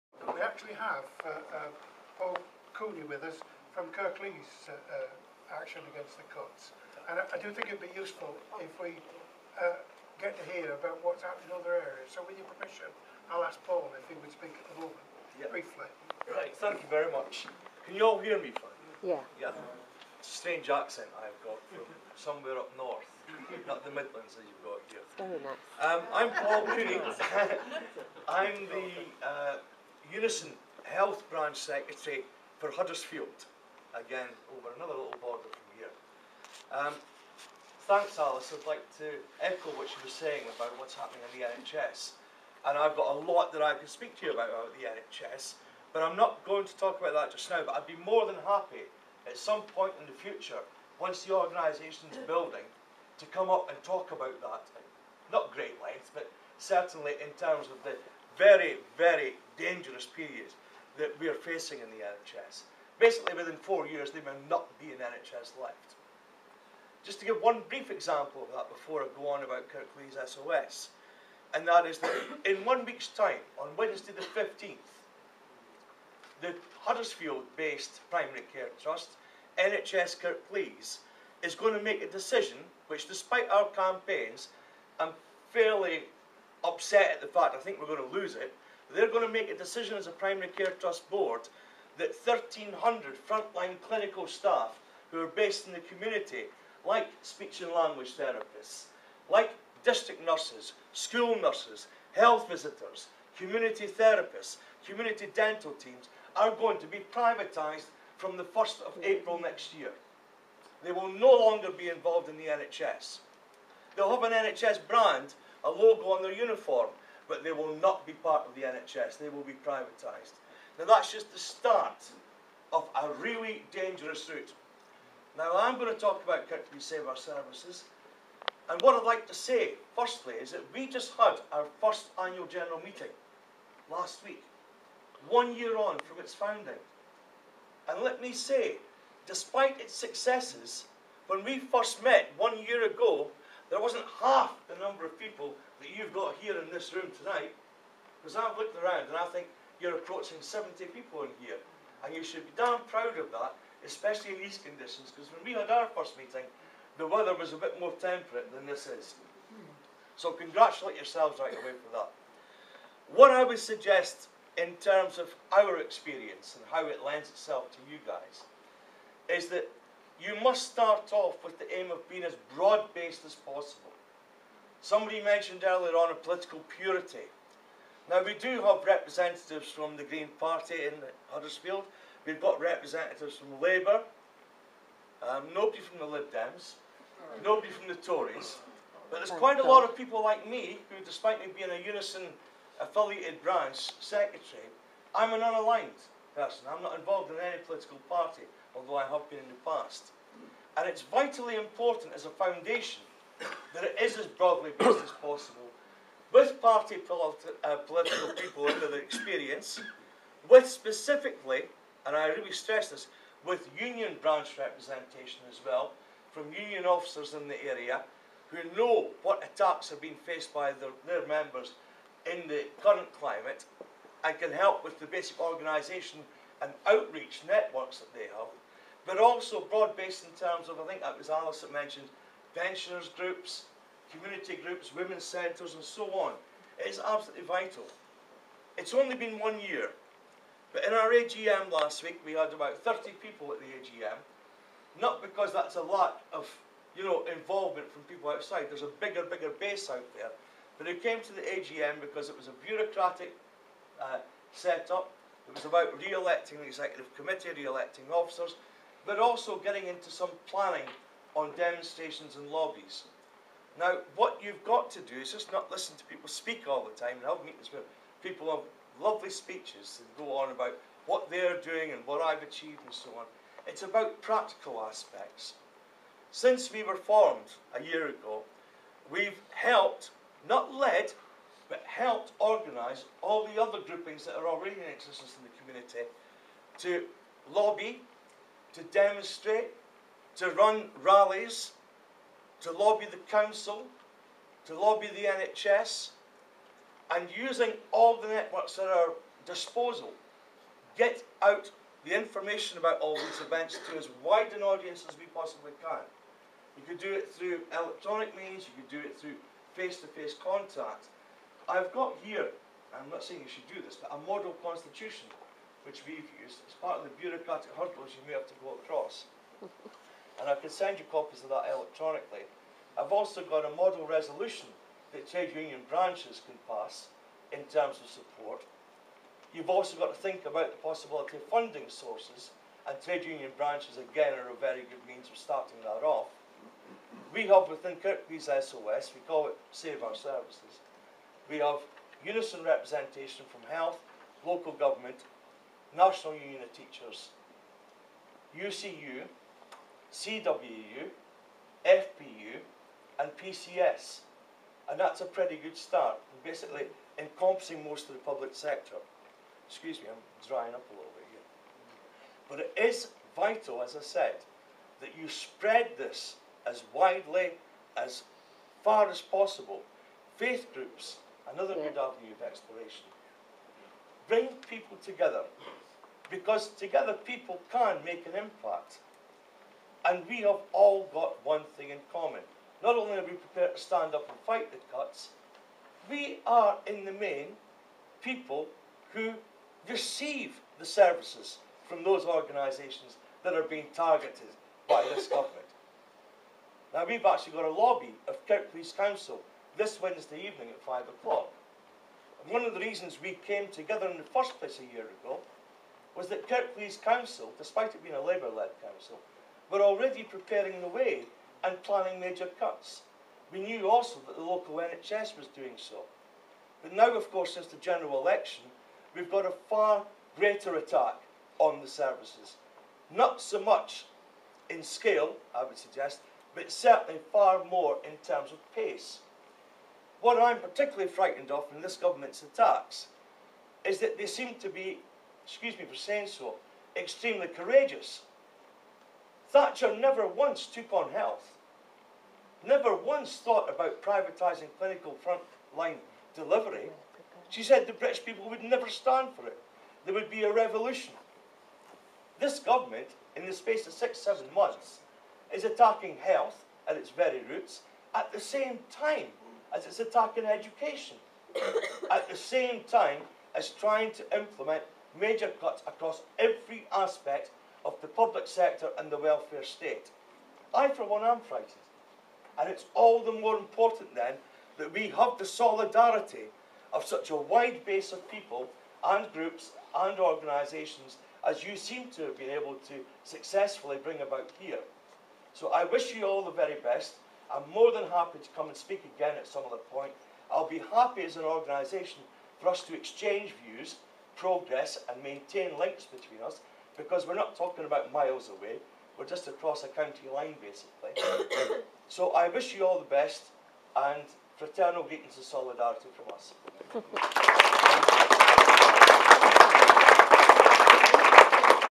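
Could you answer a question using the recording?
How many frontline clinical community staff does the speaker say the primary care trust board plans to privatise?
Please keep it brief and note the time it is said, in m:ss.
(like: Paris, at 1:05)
1,300, at 1:32.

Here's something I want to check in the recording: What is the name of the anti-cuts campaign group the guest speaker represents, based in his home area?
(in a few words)
Kirklees Save Our Services.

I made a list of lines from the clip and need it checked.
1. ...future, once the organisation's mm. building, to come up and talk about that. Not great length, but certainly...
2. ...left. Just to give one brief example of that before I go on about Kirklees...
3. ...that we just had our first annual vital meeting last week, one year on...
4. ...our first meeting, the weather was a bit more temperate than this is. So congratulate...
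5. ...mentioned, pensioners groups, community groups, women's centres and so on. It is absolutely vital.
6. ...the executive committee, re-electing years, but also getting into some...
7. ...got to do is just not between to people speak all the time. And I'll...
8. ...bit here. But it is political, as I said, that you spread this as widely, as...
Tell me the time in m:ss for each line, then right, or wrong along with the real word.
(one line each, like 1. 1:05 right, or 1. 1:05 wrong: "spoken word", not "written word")
1. 0:50 right
2. 1:05 right
3. 2:10 wrong: "general", not "vital"
4. 2:35 right
5. 3:51 right
6. 4:16 wrong: "officers", not "years"
7. 4:24 wrong: "listen", not "between"
8. 6:01 wrong: "vital", not "political".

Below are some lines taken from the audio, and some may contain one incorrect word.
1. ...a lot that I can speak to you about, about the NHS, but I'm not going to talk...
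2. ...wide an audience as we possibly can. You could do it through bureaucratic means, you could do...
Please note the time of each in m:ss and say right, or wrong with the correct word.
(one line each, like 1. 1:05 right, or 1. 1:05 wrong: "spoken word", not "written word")
1. 0:43 right
2. 5:04 wrong: "electronic", not "bureaucratic".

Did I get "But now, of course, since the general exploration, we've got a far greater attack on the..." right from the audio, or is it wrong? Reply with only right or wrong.
wrong.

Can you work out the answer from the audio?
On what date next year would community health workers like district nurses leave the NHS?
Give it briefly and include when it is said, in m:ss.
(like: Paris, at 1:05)
1st of April, at 1:48.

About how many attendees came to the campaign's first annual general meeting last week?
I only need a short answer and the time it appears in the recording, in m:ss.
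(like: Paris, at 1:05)
30, at 4:02.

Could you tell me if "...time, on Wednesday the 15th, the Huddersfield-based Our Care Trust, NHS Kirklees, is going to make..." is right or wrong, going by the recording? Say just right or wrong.
wrong.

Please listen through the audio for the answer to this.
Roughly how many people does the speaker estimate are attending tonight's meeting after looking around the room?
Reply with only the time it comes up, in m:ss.
2:30.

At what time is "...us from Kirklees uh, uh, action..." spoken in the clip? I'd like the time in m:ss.
0:03.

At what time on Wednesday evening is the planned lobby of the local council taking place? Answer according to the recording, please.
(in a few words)
5 o'clock.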